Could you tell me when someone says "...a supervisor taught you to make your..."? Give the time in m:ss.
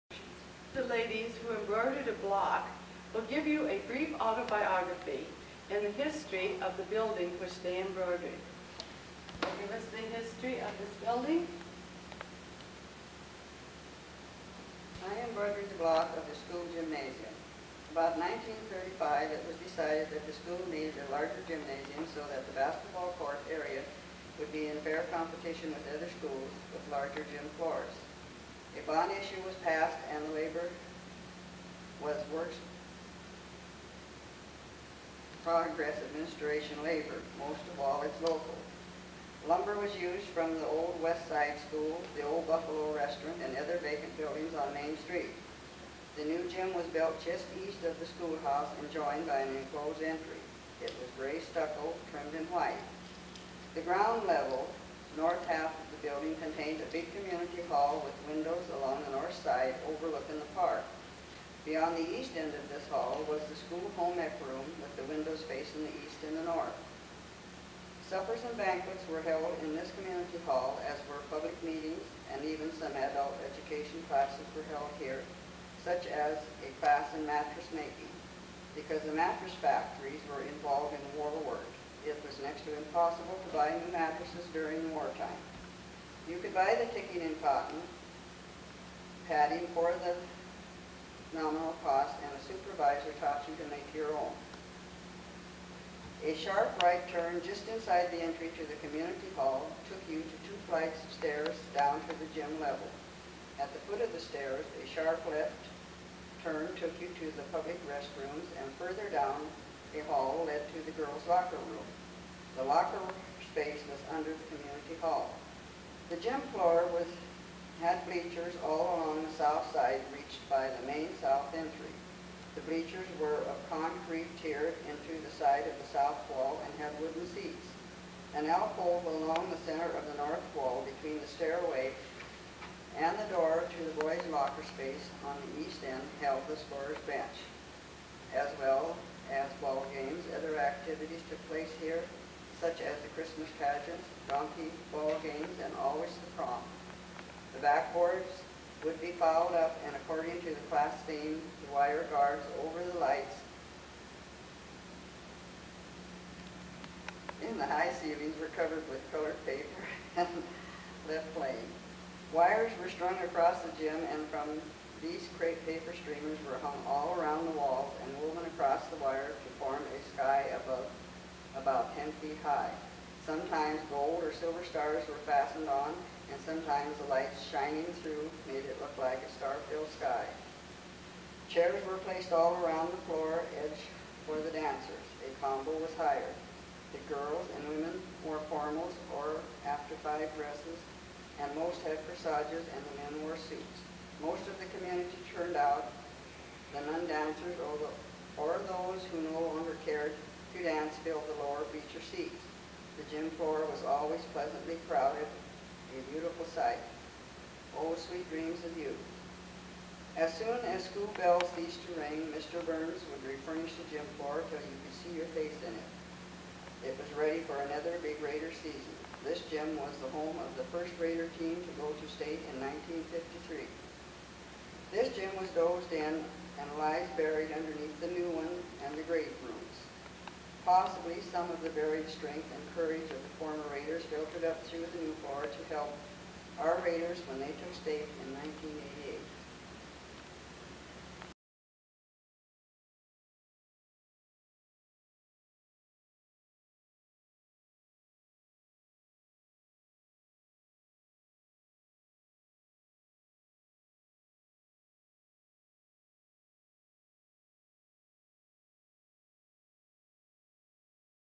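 1:32.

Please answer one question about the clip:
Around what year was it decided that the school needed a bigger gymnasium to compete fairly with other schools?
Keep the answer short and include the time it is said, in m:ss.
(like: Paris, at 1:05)
1935, at 0:18.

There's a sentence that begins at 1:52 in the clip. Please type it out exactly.
The locker space was under the community hall.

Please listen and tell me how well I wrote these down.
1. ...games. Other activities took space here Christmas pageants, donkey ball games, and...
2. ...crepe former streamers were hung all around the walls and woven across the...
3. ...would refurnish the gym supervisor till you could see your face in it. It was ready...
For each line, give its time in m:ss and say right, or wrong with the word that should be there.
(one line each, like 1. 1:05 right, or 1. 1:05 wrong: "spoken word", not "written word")
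1. 2:19 wrong: "place", not "space"
2. 2:45 wrong: "paper", not "former"
3. 3:33 wrong: "floor", not "supervisor".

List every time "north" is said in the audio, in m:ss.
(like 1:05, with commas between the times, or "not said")
0:55, 0:59, 1:06, 2:10.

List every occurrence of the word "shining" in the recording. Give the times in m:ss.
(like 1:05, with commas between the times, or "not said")
2:57.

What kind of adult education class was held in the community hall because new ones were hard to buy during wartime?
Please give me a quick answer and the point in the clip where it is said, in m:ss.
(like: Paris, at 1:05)
Mattress making, at 1:17.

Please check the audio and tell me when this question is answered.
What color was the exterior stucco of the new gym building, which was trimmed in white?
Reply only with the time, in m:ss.
0:51.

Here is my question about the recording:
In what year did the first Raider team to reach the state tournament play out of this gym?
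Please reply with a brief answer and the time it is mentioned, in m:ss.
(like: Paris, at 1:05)
1953, at 3:43.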